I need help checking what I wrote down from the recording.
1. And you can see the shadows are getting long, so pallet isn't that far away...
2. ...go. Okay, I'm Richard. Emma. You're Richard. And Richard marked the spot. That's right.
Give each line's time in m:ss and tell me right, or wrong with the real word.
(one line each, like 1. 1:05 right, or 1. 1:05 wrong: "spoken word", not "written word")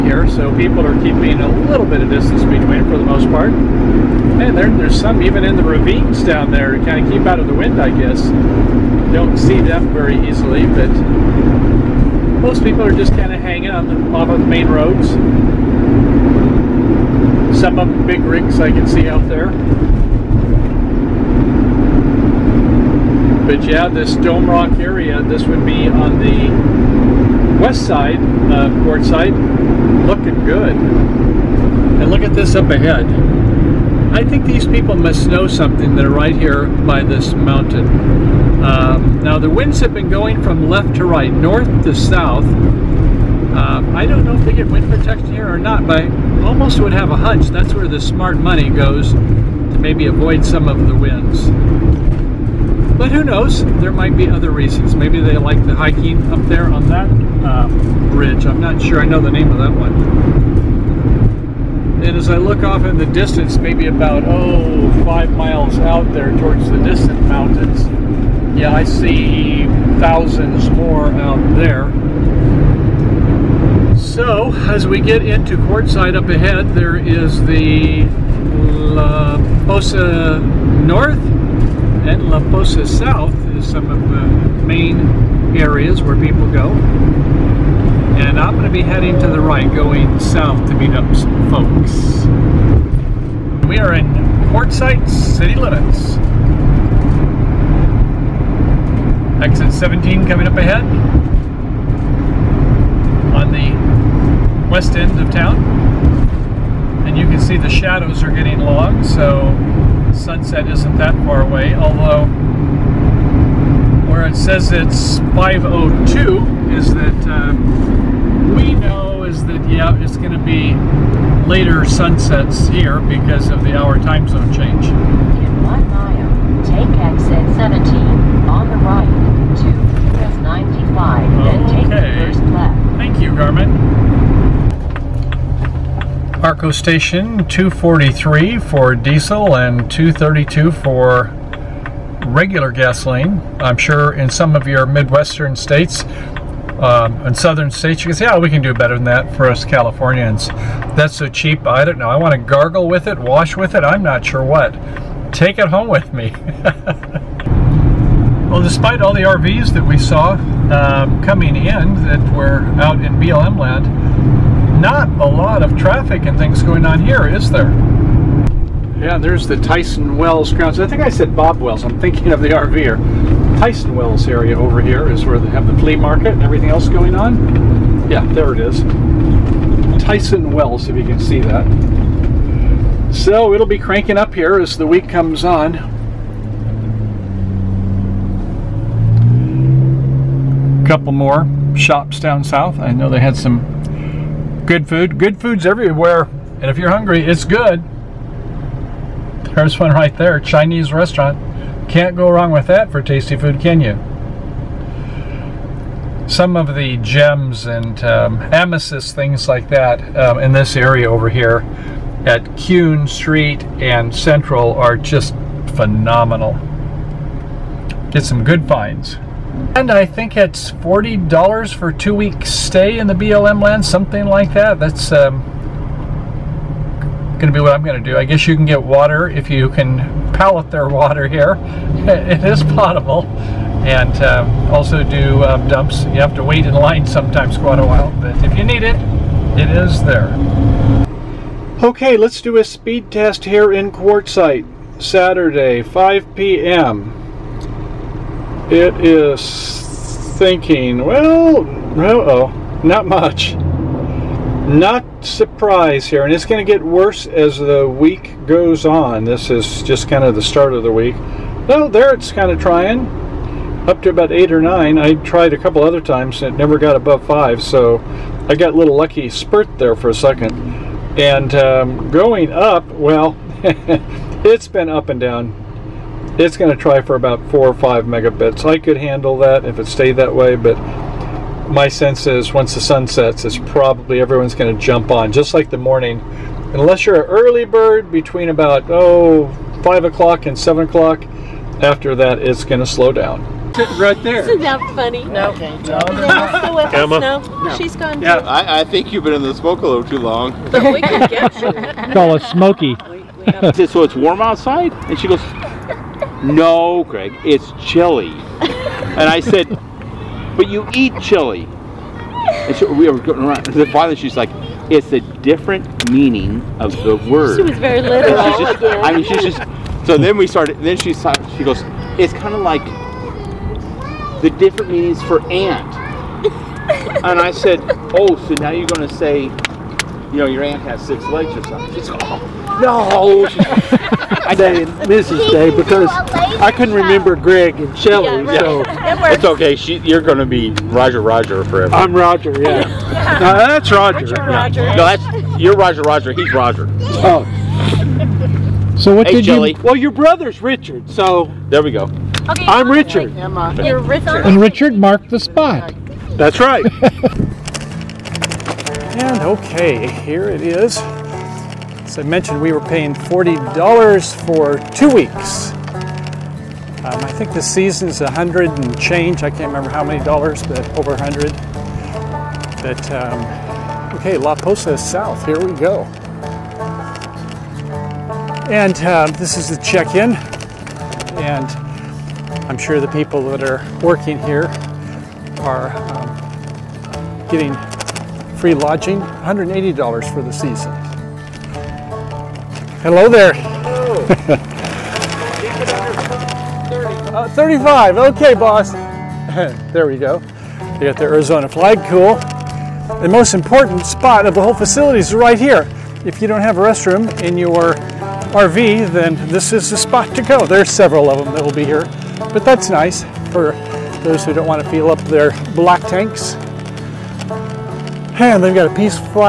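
1. 1:47 wrong: "sunset", not "pallet"
2. 5:51 right.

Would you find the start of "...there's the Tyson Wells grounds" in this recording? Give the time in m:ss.
2:49.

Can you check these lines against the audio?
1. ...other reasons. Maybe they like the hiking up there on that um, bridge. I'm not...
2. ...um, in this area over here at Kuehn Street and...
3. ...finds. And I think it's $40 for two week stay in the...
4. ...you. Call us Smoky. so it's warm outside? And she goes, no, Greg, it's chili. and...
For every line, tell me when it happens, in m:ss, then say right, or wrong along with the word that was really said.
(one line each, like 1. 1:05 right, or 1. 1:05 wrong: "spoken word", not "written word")
1. 0:54 right
2. 3:30 right
3. 3:38 right
4. 5:01 right.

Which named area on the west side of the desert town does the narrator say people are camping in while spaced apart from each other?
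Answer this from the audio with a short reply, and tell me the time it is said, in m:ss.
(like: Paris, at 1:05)
Dome Rock, at 0:24.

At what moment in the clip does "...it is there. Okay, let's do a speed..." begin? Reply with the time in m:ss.
3:59.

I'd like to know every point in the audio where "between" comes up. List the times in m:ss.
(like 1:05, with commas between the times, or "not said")
0:02, 4:48.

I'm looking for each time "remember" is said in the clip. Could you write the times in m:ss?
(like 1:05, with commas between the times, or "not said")
5:36, 6:09.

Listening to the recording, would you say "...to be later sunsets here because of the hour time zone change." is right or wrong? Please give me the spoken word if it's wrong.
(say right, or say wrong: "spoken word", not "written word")
right.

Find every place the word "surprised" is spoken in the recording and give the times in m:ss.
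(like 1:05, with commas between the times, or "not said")
4:15.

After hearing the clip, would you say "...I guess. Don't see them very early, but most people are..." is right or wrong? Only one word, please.
wrong.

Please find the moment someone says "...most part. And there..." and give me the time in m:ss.
0:03.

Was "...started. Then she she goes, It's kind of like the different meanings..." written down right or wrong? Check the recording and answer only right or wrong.
right.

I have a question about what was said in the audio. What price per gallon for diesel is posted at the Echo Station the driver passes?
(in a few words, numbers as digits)
243.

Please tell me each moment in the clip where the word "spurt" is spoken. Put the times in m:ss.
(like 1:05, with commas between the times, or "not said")
4:29.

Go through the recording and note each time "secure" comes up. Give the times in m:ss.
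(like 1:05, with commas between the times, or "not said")
not said.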